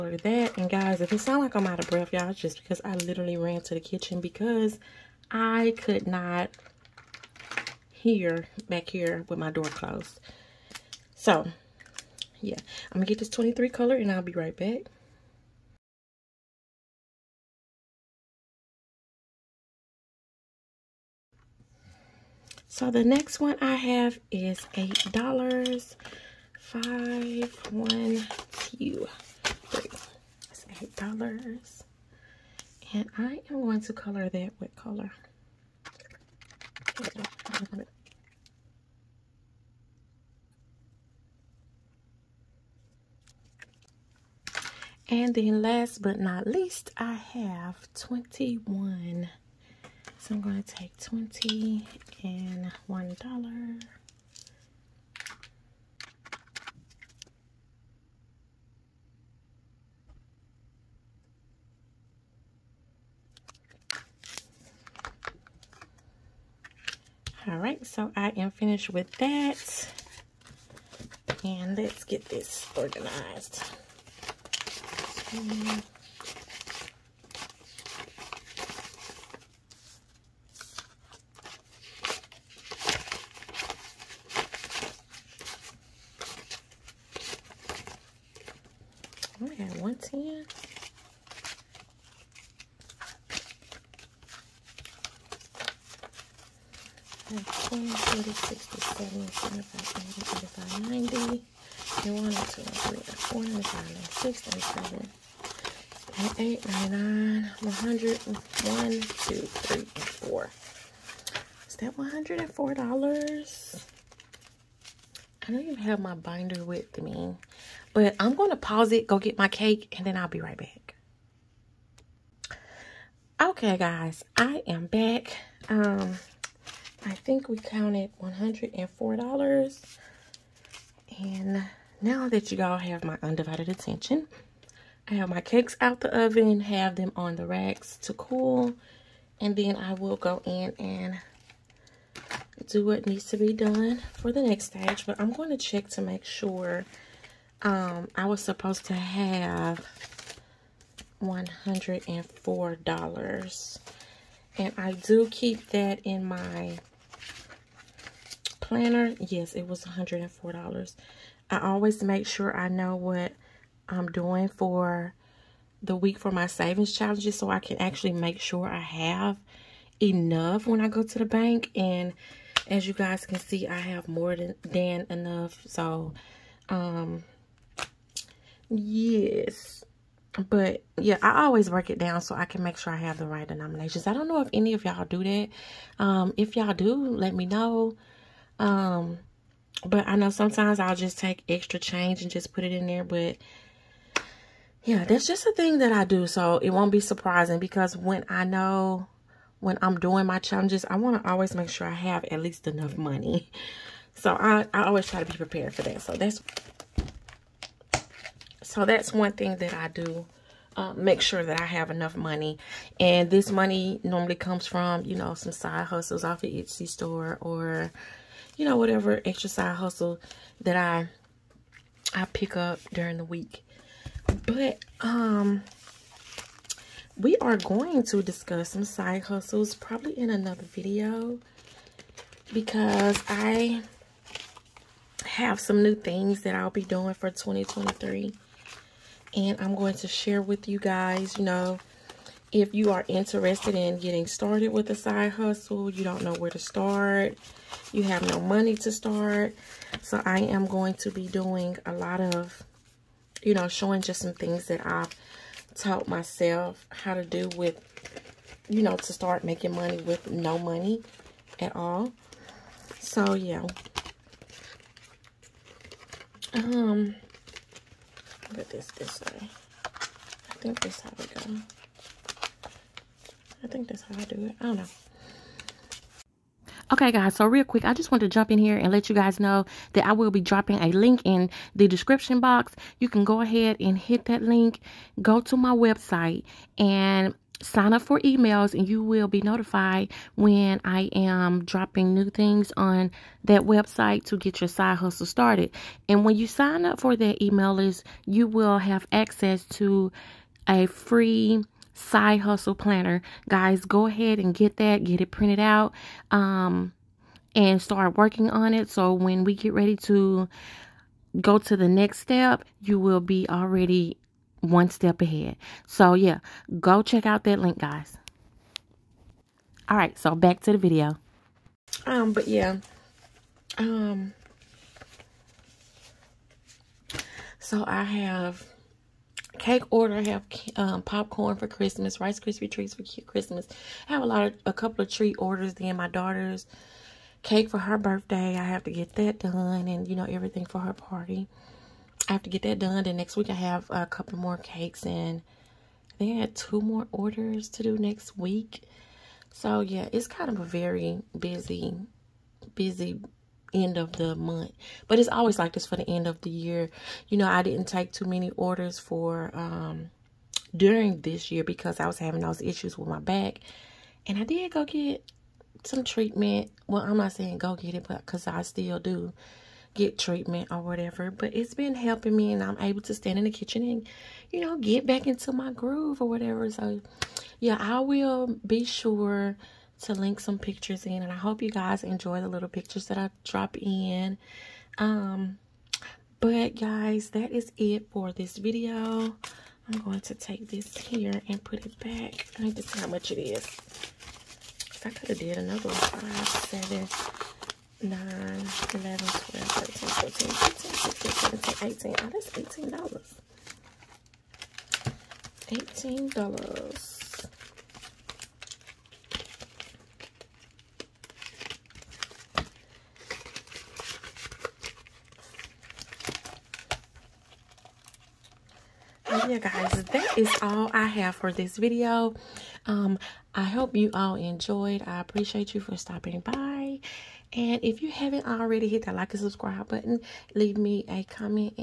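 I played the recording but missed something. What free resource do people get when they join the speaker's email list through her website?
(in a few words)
side hustle planner.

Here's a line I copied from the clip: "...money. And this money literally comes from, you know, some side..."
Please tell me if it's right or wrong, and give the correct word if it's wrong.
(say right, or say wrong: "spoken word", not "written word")
wrong: "normally", not "literally".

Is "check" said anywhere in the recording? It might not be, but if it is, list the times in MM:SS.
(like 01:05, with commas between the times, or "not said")
02:25, 05:17.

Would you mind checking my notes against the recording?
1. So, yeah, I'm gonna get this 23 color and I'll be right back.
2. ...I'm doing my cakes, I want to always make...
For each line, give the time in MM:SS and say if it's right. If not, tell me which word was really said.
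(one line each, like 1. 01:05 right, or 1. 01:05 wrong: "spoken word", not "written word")
1. 00:11 right
2. 03:19 wrong: "challenges", not "cakes".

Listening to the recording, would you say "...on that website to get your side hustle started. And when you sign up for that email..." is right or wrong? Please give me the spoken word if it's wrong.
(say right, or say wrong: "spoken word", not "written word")
right.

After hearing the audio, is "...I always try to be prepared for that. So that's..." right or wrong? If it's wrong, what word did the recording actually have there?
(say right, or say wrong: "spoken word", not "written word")
right.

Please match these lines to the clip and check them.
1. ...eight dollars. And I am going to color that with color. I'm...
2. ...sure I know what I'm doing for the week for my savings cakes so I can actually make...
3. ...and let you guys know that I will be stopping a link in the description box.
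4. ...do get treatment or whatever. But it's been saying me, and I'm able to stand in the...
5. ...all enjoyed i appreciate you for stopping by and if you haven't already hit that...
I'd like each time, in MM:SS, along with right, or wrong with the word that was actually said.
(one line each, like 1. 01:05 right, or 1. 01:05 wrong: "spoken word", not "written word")
1. 00:30 right
2. 02:42 wrong: "challenges", not "cakes"
3. 04:38 wrong: "dropping", not "stopping"
4. 06:08 wrong: "helping", not "saying"
5. 07:04 right.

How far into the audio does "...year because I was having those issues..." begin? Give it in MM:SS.
06:01.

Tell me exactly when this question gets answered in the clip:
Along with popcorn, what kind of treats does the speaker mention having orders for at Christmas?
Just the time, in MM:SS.
05:32.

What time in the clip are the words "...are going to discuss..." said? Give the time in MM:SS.
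03:47.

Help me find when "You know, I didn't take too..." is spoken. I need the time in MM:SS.
05:57.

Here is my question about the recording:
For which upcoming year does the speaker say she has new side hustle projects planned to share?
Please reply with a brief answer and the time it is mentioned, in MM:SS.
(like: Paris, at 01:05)
2023, at 03:57.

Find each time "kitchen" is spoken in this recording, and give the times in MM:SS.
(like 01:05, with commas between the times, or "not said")
00:03, 06:13.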